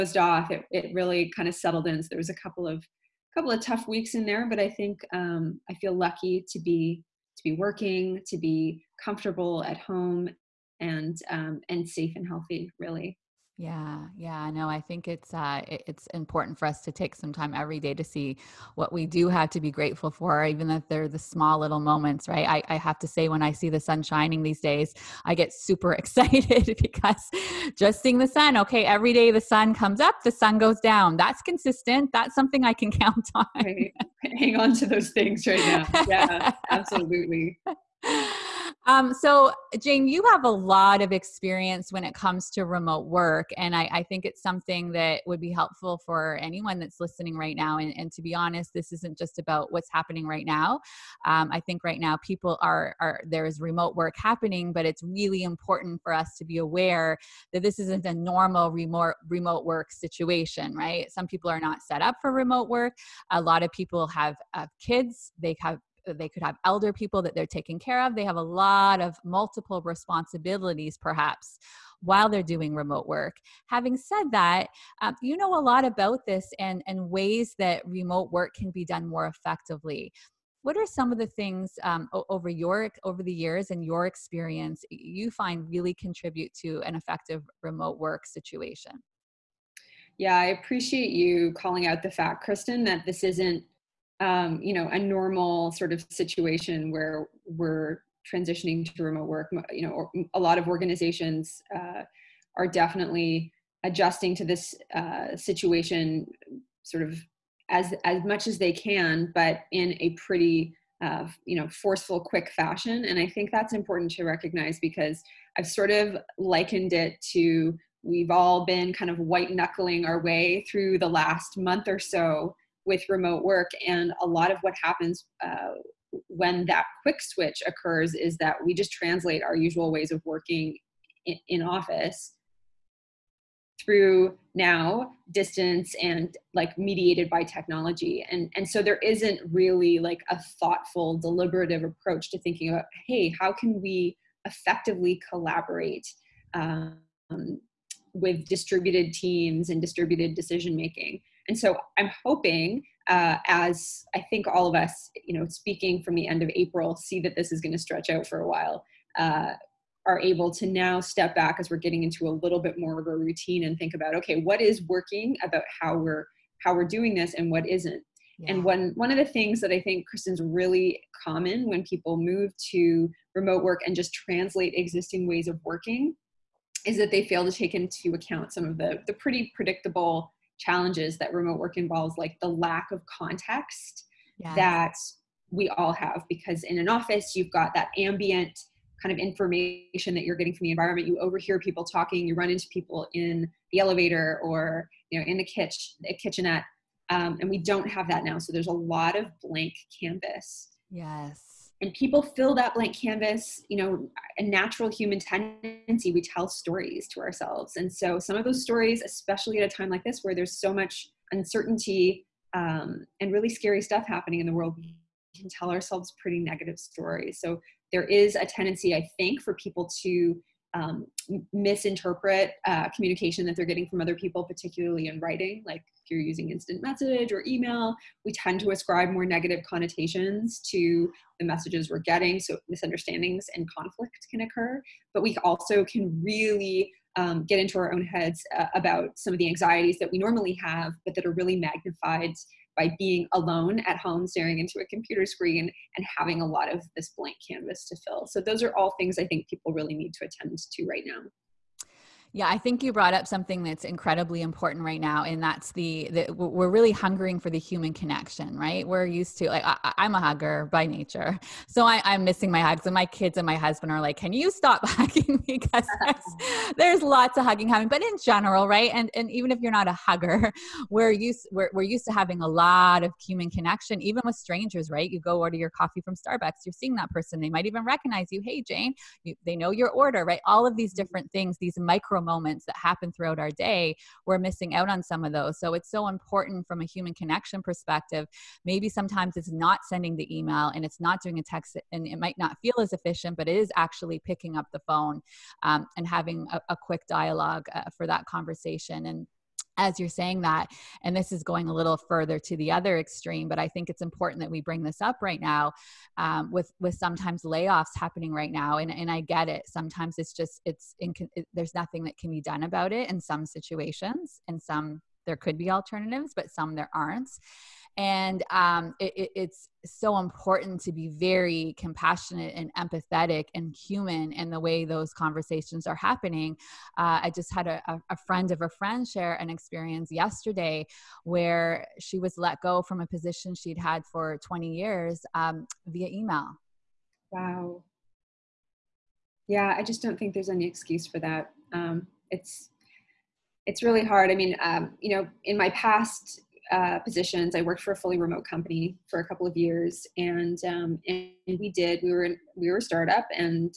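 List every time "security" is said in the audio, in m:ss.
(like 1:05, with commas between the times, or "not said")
not said.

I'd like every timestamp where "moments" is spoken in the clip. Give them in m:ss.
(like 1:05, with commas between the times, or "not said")
0:21, 4:42.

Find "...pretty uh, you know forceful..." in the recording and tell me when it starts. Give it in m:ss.
1:50.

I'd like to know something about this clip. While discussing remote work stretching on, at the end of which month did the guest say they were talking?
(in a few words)
April.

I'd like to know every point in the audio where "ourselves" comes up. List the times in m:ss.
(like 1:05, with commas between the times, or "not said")
3:27, 3:35.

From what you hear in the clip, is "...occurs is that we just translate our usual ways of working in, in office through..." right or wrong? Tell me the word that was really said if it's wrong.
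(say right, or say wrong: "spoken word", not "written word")
right.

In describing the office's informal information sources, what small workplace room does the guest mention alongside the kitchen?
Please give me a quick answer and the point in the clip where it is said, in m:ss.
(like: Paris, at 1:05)
kitchenette, at 3:16.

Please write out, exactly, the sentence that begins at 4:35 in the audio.
You go order your coffee from Starbucks, you're seeing that person, they might even recognize you.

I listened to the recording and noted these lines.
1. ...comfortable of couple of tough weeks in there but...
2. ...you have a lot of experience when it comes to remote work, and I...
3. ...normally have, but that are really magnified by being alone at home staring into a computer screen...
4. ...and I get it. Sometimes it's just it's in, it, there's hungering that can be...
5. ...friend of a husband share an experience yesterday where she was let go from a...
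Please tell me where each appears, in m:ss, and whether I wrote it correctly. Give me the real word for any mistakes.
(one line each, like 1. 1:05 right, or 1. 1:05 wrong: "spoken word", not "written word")
1. 0:02 wrong: "couple", not "comfortable"
2. 0:40 right
3. 4:00 right
4. 5:08 wrong: "nothing", not "hungering"
5. 5:28 wrong: "friend", not "husband".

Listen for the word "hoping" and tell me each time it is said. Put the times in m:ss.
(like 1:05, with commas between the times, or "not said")
2:32.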